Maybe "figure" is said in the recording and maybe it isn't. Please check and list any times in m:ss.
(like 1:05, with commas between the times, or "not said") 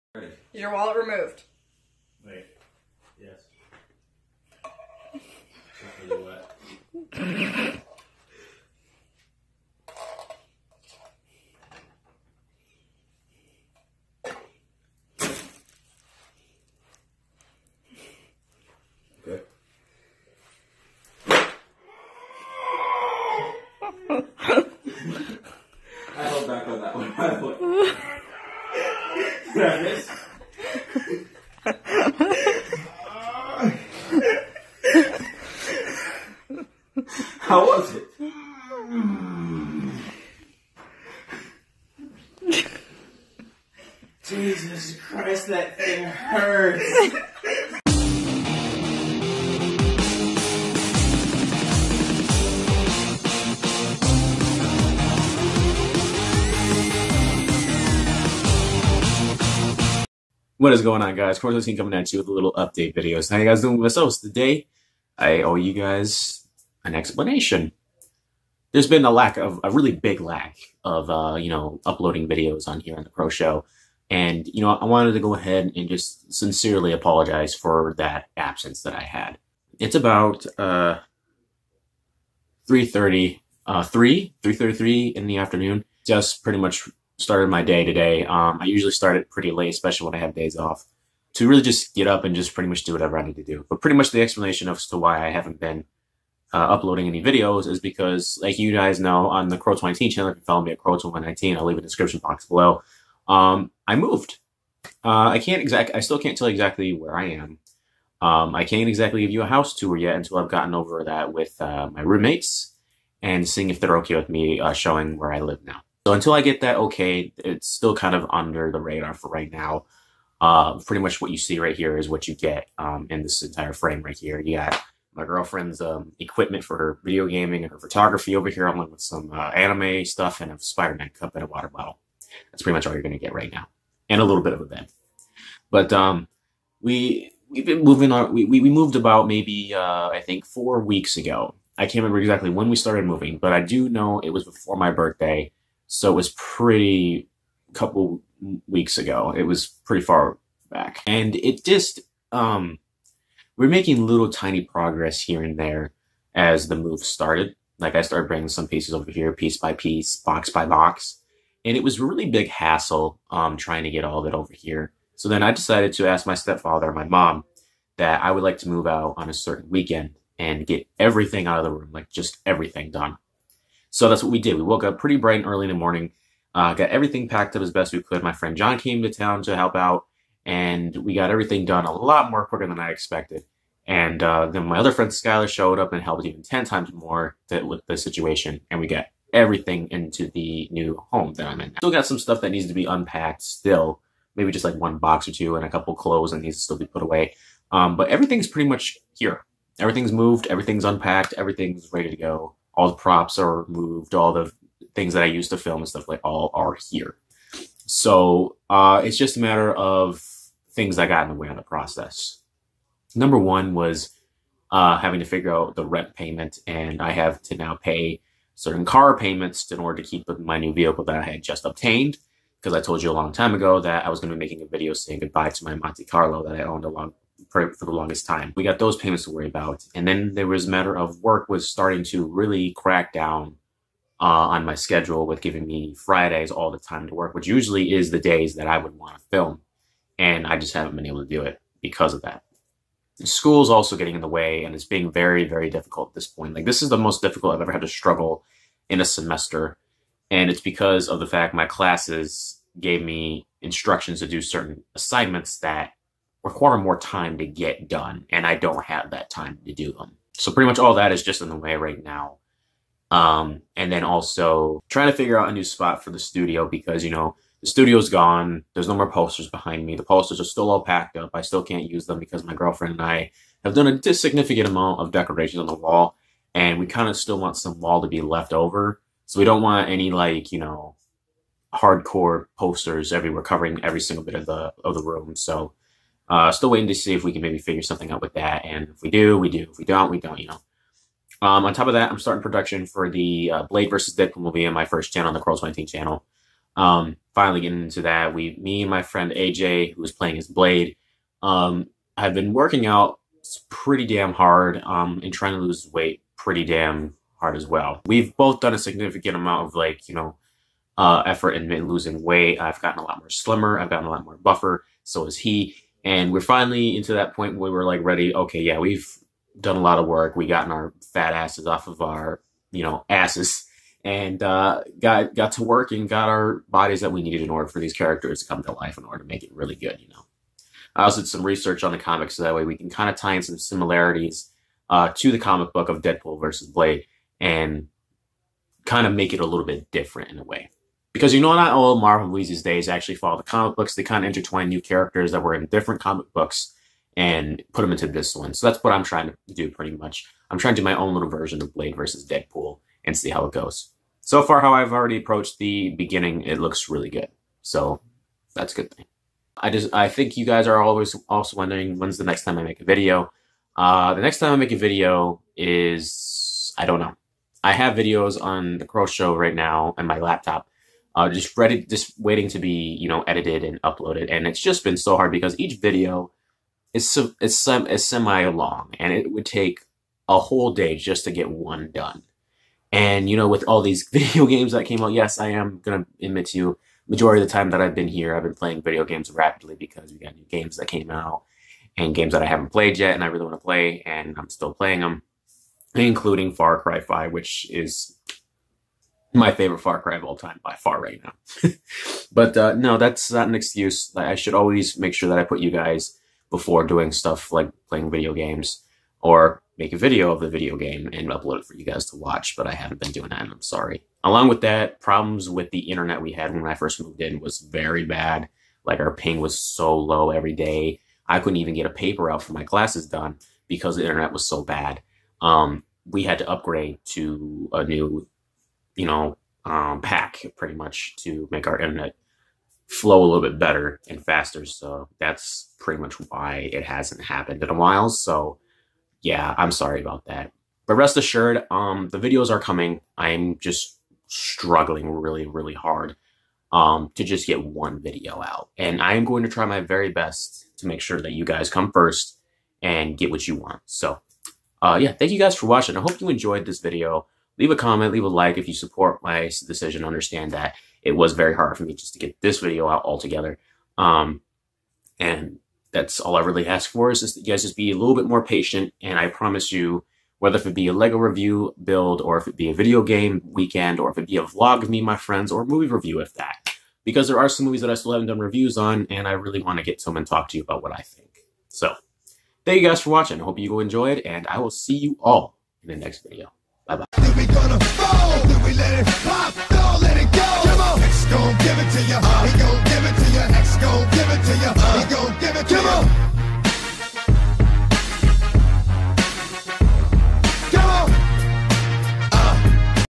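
3:35, 4:25, 4:47.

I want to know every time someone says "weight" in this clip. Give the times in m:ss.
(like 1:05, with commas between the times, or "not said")
5:05, 5:12.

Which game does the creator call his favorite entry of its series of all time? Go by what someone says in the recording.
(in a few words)
Far Cry 5.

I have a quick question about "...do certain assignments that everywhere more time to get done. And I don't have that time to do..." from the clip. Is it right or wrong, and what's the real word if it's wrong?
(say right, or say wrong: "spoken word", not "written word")
wrong: "require", not "everywhere".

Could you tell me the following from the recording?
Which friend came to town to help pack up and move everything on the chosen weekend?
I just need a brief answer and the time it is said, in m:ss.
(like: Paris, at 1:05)
John, at 2:58.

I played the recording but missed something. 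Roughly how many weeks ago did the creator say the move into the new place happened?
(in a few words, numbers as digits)
4.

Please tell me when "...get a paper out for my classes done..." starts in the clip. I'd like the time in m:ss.
7:01.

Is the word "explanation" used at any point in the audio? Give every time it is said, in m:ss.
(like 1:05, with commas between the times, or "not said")
1:06, 1:34.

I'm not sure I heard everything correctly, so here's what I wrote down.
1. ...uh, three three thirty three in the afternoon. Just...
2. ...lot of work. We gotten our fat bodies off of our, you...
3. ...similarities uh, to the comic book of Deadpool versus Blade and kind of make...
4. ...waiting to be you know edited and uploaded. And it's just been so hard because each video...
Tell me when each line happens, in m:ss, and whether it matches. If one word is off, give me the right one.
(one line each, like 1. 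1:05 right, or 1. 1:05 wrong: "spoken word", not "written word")
1. 1:23 right
2. 5:19 wrong: "asses", not "bodies"
3. 5:33 right
4. 6:12 right.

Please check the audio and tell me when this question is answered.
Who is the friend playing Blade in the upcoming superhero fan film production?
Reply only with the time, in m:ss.
4:59.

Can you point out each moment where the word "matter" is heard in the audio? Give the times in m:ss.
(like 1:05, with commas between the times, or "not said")
3:29, 3:50.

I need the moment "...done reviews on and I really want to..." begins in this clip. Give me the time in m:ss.
7:58.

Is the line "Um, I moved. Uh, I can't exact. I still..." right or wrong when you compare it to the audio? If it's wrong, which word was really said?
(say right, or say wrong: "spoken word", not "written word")
right.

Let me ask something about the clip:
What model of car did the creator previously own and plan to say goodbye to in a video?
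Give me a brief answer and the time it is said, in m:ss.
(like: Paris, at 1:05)
Monte Carlo, at 3:45.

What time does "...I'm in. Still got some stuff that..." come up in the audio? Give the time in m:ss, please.
3:11.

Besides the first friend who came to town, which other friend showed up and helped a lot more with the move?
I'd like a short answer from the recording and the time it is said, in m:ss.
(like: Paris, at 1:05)
Skylar, at 3:05.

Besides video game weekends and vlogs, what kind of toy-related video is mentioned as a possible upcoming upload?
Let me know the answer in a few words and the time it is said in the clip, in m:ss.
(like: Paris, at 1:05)
Lego review build, at 7:50.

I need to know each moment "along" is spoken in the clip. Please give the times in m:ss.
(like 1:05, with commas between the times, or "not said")
2:08, 6:54.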